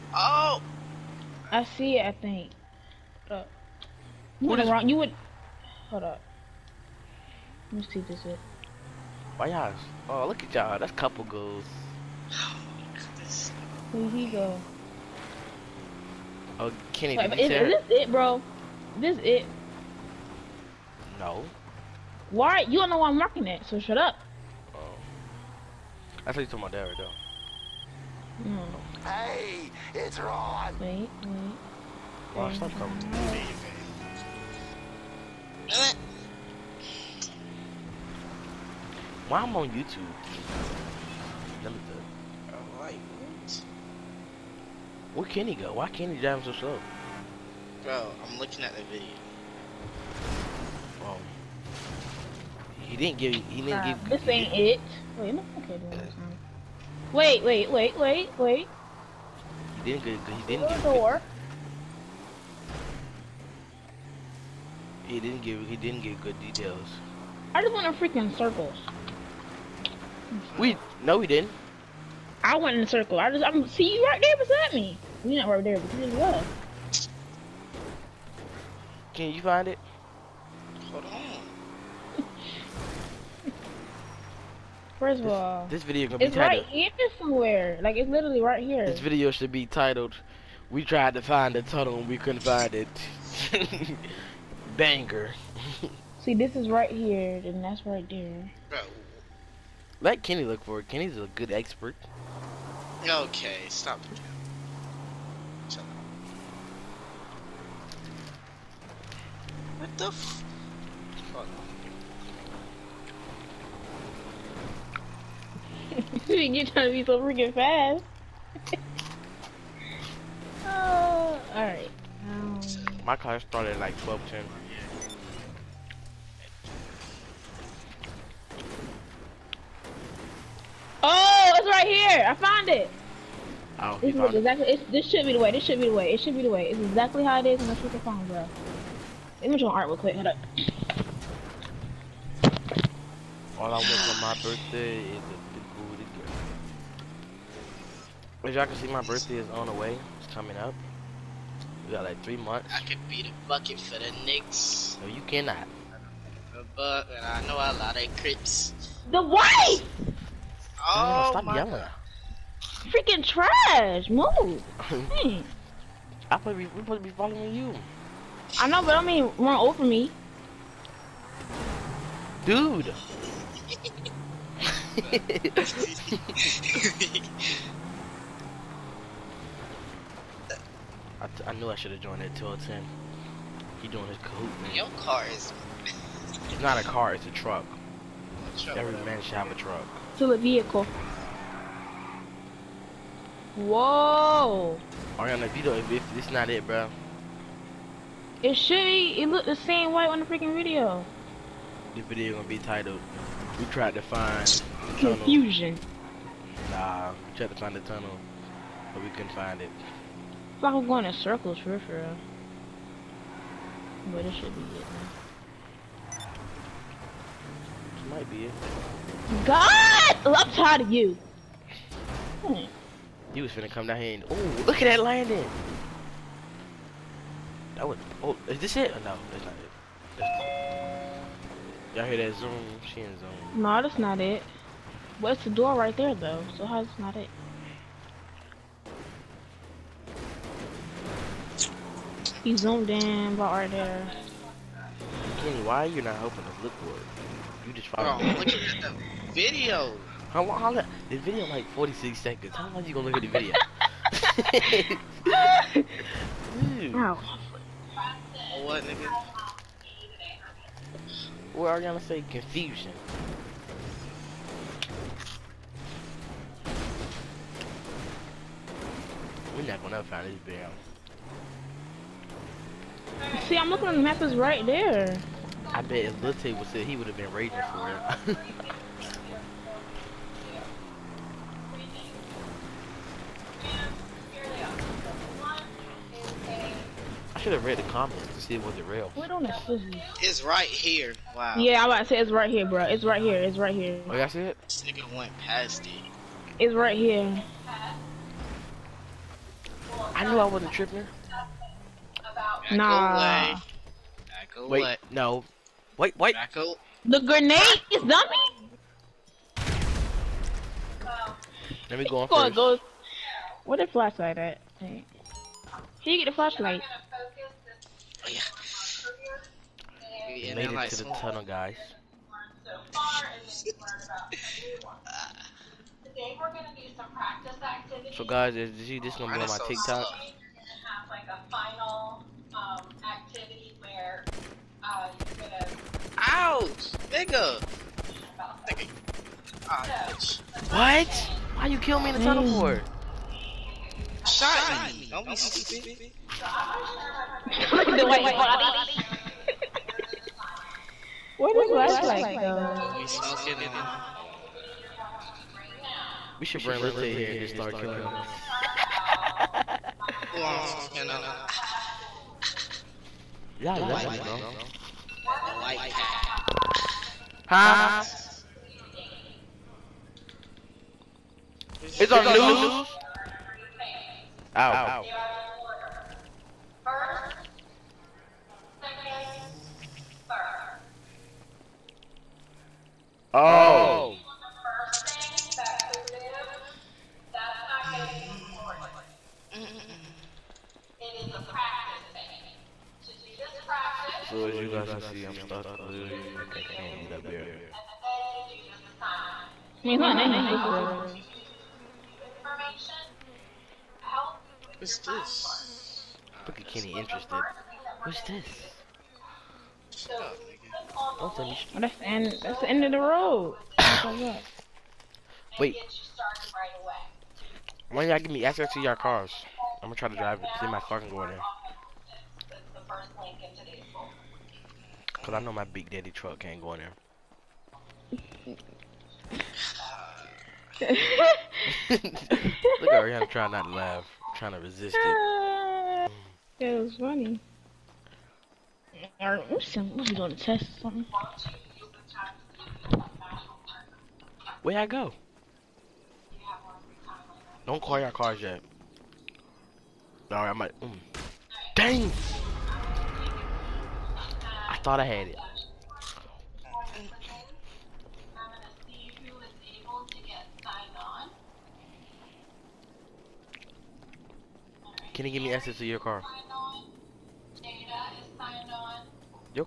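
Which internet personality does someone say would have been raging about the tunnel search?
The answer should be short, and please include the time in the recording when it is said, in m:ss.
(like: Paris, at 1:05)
Lil Tay, at 4:36.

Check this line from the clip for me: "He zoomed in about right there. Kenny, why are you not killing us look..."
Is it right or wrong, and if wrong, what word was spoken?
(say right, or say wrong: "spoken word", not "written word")
wrong: "helping", not "killing".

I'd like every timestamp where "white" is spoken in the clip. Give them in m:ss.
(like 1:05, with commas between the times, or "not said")
2:39, 3:19, 5:48.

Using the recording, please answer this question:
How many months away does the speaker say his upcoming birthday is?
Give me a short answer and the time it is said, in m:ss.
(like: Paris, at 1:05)
3, at 2:32.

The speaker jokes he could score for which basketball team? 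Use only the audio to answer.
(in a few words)
Knicks.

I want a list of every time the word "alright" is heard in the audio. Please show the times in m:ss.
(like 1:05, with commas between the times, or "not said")
2:01, 7:19, 7:30.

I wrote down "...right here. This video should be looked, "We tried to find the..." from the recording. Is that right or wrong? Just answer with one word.
wrong.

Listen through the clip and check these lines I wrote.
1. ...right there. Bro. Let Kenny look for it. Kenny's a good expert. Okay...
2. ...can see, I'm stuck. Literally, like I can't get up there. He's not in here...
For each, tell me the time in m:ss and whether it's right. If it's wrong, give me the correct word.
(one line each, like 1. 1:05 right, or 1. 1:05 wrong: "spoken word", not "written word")
1. 1:37 right
2. 6:34 right.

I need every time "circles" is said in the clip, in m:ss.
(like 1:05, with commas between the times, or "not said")
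1:08, 1:12, 3:31.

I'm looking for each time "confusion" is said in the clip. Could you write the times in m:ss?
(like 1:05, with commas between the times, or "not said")
3:24, 4:22.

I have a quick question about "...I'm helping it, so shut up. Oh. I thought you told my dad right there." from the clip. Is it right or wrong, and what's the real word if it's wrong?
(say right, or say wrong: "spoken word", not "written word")
wrong: "marking", not "helping".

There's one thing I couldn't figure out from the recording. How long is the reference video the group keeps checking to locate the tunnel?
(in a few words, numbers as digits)
46 seconds.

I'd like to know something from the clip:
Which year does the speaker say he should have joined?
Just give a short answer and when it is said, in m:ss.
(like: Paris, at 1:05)
2010, at 3:02.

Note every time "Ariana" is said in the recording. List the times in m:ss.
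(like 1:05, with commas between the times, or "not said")
3:15, 7:12.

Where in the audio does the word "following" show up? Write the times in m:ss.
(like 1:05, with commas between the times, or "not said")
2:47.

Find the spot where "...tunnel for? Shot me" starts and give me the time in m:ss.
5:42.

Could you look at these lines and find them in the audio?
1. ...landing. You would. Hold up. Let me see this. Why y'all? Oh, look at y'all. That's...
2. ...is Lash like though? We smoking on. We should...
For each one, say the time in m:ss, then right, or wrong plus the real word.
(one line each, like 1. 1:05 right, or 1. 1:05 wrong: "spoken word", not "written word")
1. 0:04 wrong: "wrong", not "landing"
2. 5:51 right.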